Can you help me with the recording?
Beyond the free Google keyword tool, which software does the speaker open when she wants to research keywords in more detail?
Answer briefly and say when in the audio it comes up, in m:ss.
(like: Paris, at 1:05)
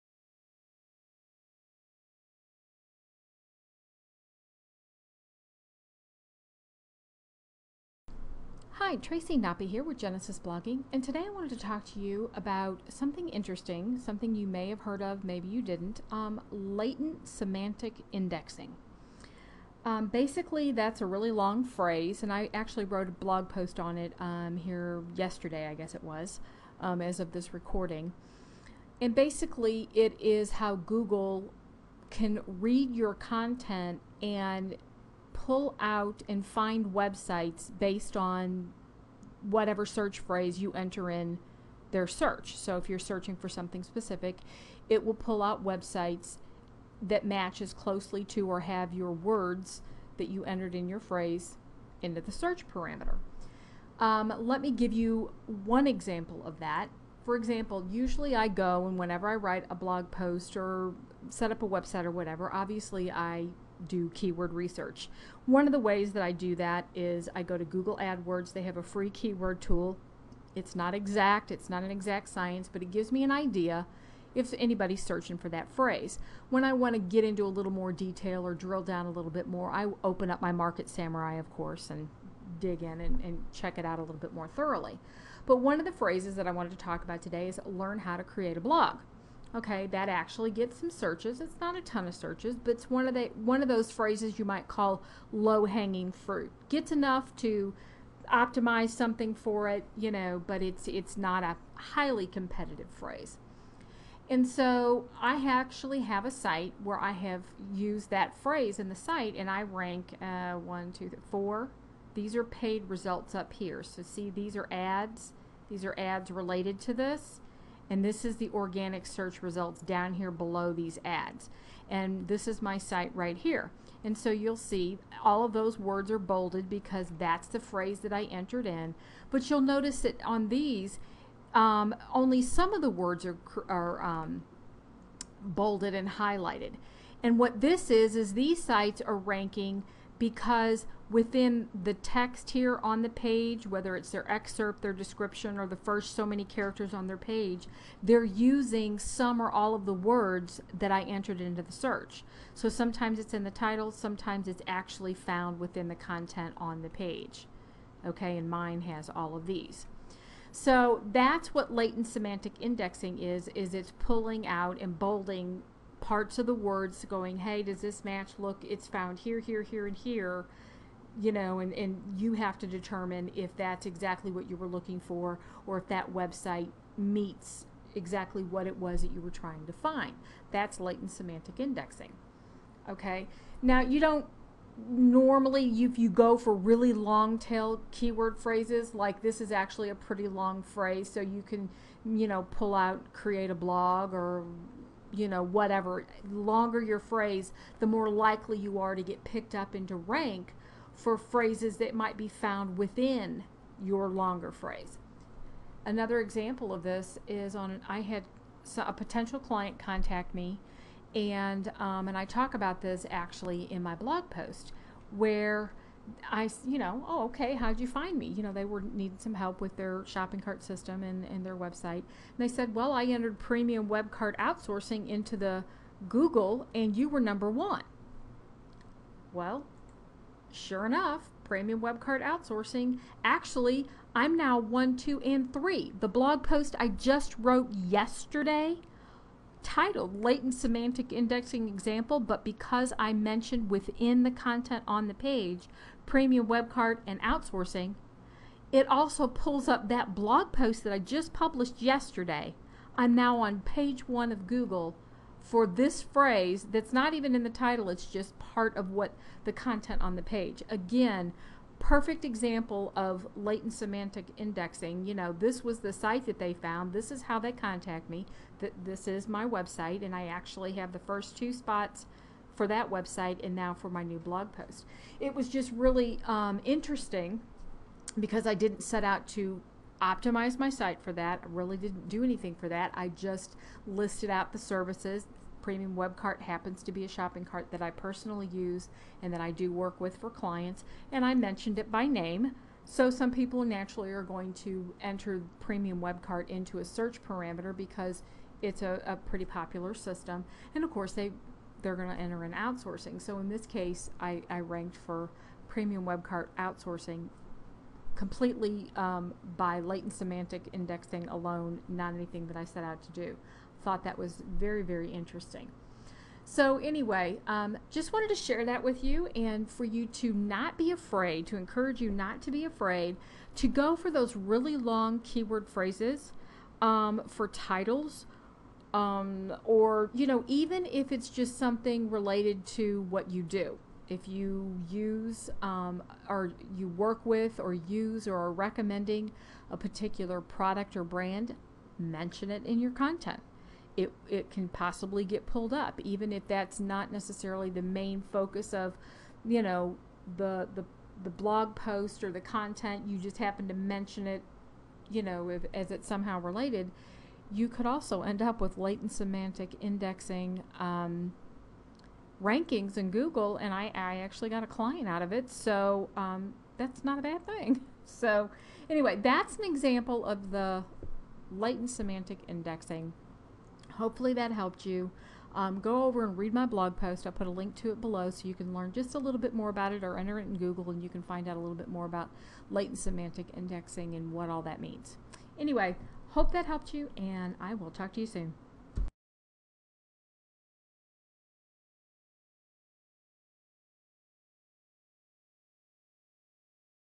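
Market Samurai, at 1:20.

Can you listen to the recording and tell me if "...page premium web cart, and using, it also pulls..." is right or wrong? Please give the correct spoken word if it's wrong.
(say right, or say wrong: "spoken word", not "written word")
wrong: "outsourcing", not "using".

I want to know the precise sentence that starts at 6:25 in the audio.
Anyway, Hope that helped you, and I will talk to you soon.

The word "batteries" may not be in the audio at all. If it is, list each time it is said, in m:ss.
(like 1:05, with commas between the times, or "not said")
not said.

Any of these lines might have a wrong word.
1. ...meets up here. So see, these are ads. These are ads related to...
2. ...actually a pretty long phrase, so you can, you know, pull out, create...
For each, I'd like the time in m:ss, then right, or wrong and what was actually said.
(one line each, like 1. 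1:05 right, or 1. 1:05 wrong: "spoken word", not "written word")
1. 1:52 wrong: "results", not "meets"
2. 3:09 right.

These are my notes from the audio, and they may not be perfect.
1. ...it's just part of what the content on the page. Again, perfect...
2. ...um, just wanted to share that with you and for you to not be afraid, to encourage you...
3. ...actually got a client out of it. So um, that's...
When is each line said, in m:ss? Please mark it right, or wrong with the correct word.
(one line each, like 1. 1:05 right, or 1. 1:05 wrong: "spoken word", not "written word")
1. 4:17 right
2. 5:17 right
3. 6:04 right.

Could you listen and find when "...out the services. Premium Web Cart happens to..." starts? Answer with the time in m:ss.
4:44.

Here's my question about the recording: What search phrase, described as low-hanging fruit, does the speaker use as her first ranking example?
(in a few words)
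learn how to create a blog.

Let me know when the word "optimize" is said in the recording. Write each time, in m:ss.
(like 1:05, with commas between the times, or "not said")
1:38, 4:40.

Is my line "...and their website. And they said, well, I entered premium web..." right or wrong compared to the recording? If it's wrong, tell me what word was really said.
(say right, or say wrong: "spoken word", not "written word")
right.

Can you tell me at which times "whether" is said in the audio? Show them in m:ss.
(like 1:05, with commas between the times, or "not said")
2:23.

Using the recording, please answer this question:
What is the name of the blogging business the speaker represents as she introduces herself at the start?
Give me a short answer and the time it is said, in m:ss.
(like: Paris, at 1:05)
Genesis Blogging, at 0:09.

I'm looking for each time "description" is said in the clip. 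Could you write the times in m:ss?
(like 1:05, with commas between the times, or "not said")
2:24.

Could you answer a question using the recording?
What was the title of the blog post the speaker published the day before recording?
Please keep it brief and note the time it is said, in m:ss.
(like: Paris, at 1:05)
Latent Semantic Indexing Example, at 4:00.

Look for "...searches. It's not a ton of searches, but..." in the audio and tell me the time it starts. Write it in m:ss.
1:30.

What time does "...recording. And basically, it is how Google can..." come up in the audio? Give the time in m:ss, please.
0:27.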